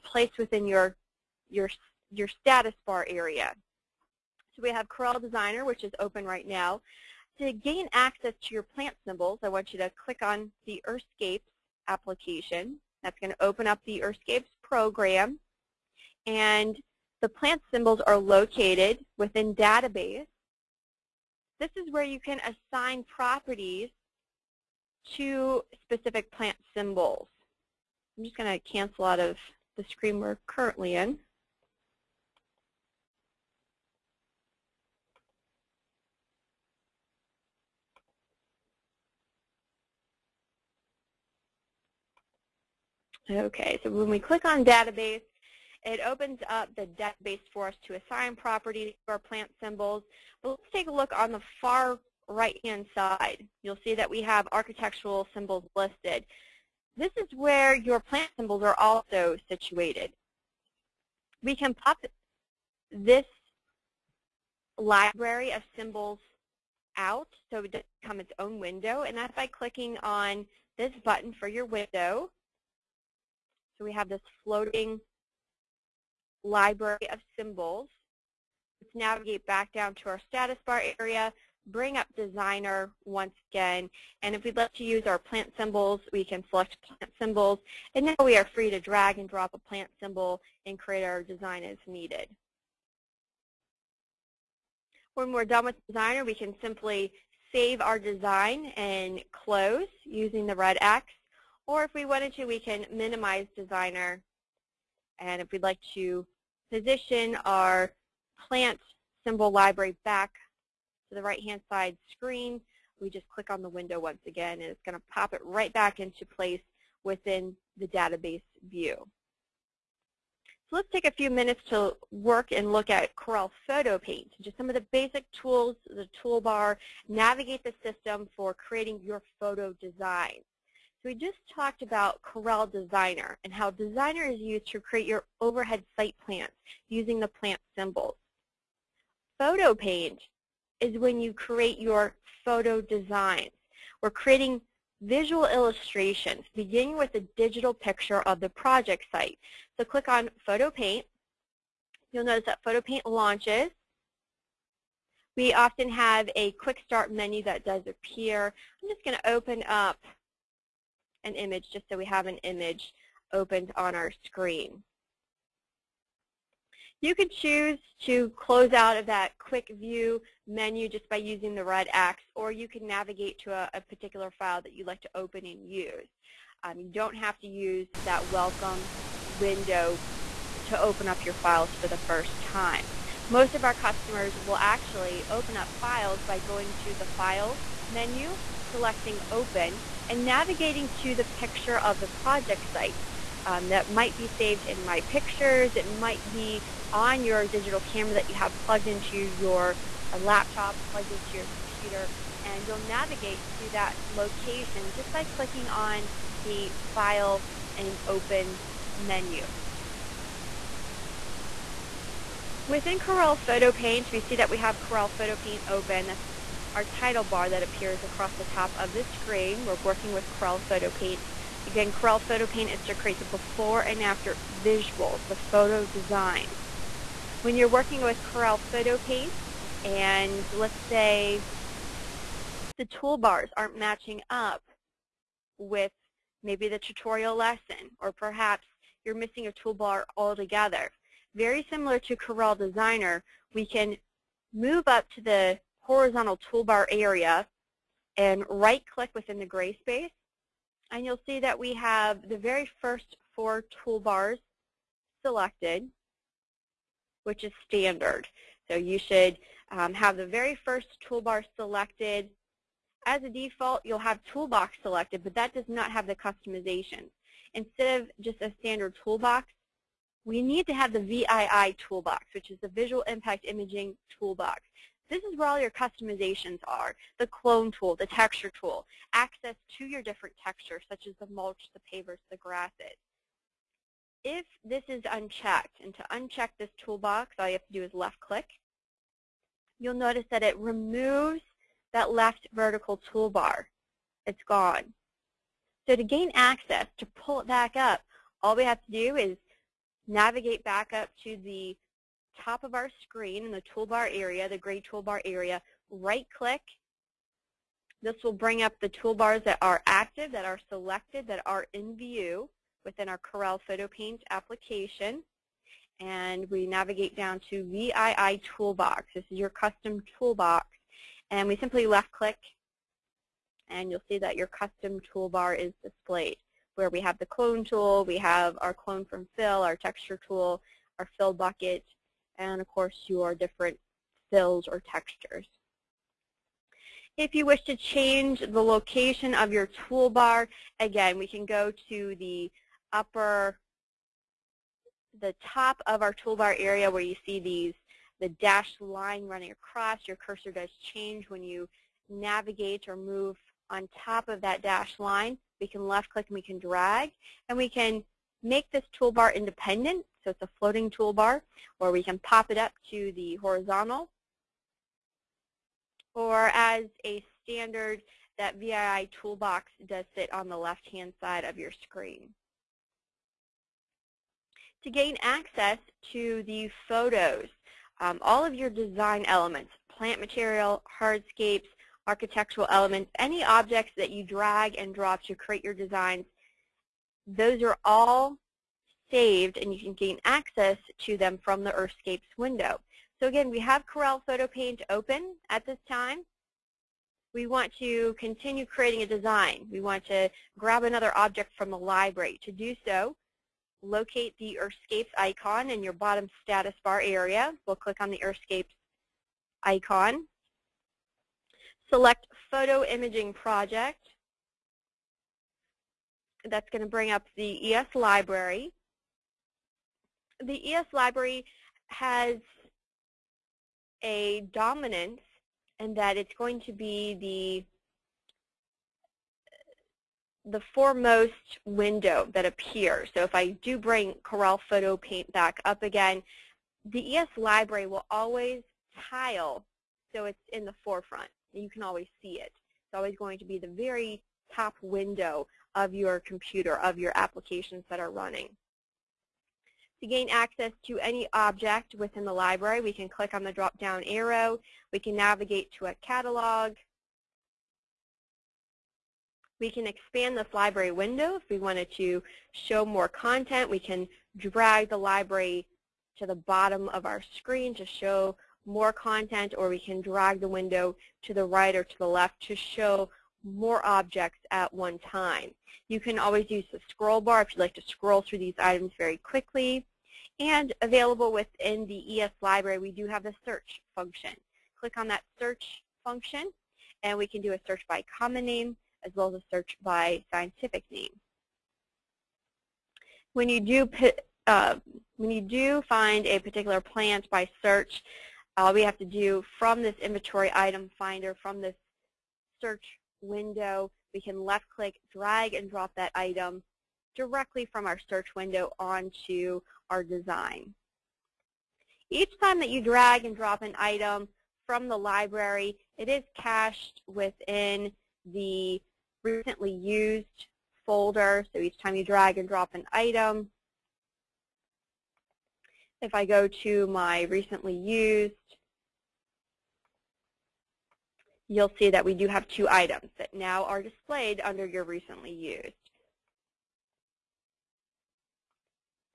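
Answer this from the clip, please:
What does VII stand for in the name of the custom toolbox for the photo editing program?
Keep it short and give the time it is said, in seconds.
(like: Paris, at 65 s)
Visual Impact Imaging, at 272 s.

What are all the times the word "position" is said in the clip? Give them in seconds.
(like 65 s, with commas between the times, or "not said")
106 s.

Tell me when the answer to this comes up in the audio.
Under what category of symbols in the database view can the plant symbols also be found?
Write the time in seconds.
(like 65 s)
54 s.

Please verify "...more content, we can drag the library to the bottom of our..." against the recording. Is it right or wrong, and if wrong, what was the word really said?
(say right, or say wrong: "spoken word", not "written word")
right.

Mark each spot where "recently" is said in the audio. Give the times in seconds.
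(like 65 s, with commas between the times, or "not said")
519 s, 527 s, 534 s.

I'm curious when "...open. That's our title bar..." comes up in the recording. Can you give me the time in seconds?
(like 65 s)
215 s.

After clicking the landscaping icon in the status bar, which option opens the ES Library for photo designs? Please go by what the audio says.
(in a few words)
Photo Imaging Project.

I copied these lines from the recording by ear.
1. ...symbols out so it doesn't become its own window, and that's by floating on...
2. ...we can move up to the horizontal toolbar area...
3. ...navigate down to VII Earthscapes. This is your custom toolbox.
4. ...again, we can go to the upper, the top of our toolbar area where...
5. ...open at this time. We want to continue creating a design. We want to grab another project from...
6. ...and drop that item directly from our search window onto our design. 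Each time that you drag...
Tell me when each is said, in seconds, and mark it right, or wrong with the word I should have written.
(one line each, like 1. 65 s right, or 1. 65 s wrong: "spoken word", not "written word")
1. 65 s wrong: "clicking", not "floating"
2. 243 s right
3. 316 s wrong: "Toolbox", not "Earthscapes"
4. 340 s right
5. 394 s wrong: "object", not "project"
6. 505 s right.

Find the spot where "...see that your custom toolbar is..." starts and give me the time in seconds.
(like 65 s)
324 s.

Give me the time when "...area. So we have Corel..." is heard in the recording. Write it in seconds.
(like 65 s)
3 s.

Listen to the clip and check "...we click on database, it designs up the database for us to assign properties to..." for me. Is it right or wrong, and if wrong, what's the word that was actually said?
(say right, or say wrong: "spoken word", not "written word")
wrong: "opens", not "designs".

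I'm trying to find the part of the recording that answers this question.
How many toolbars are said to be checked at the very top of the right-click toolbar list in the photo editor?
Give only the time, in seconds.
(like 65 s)
253 s.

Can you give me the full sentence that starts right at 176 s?
Um, you don't have to use that welcome window to open up your files for the first time.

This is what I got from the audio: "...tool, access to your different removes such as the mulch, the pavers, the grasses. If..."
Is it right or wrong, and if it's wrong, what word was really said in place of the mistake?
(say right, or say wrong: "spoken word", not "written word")
wrong: "textures", not "removes".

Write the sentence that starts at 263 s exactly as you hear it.
As a default, you'll have toolbox selected, but that does not have the customization.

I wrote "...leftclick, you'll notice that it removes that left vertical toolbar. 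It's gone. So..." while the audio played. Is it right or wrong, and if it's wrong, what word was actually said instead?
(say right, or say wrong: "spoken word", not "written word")
wrong: "click", not "leftclick".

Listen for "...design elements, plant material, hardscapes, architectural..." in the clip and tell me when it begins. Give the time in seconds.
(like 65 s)
378 s.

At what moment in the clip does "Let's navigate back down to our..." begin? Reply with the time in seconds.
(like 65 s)
78 s.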